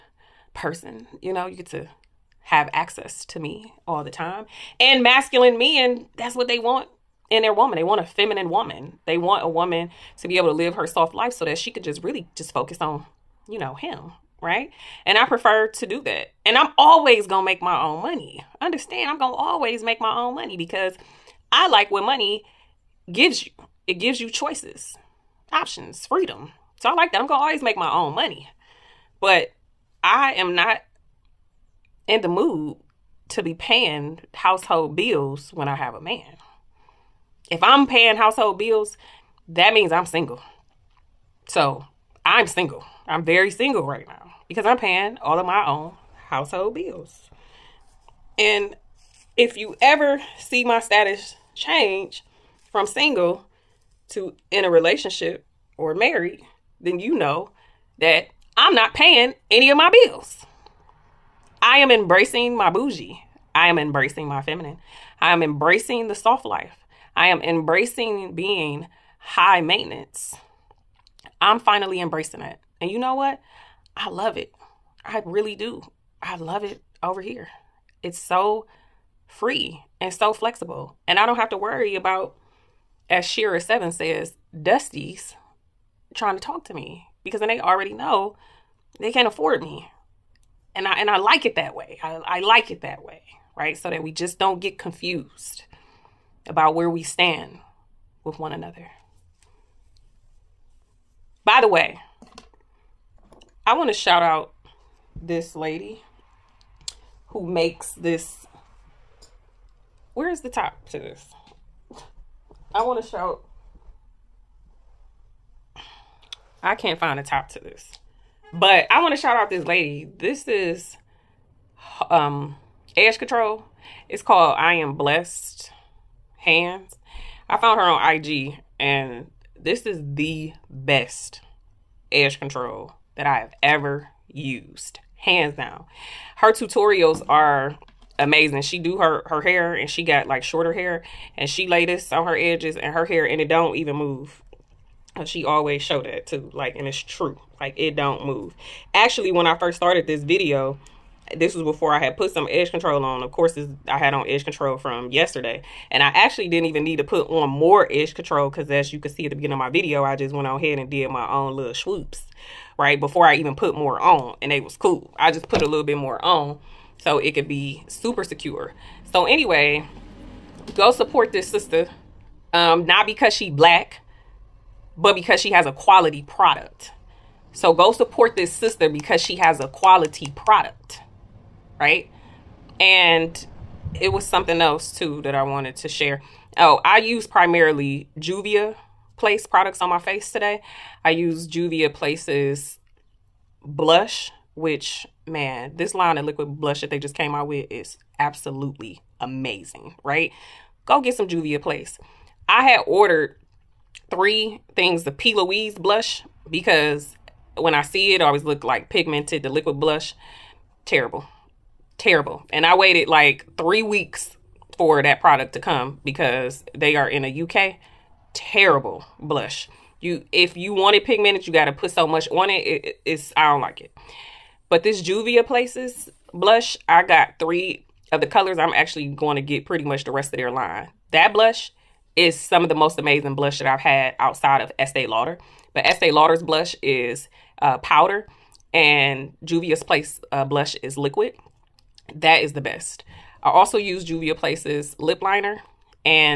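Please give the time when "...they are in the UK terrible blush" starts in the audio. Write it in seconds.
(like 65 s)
216 s.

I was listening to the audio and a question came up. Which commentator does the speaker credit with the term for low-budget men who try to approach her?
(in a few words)
Shera Seven.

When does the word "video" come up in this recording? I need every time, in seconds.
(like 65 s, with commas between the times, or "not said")
150 s, 159 s.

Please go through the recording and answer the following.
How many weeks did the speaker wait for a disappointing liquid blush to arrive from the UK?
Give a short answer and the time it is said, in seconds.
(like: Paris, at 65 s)
3, at 213 s.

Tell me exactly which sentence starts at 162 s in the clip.
Before I even put more on and it was cool.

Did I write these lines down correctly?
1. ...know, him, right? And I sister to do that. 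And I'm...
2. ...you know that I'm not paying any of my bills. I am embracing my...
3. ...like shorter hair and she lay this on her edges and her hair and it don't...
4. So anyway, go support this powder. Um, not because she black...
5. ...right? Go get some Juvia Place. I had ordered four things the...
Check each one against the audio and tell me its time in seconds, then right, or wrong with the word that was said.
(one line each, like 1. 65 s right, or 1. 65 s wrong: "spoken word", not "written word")
1. 13 s wrong: "prefer", not "sister"
2. 57 s right
3. 140 s right
4. 169 s wrong: "sister", not "powder"
5. 200 s wrong: "three", not "four".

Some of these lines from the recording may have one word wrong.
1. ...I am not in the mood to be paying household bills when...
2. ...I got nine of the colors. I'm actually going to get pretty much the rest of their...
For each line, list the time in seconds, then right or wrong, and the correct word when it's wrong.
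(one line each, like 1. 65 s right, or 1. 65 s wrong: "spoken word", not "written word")
1. 30 s right
2. 226 s wrong: "three", not "nine".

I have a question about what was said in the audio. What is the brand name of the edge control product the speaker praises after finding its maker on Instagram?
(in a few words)
I Am Blessed Hands.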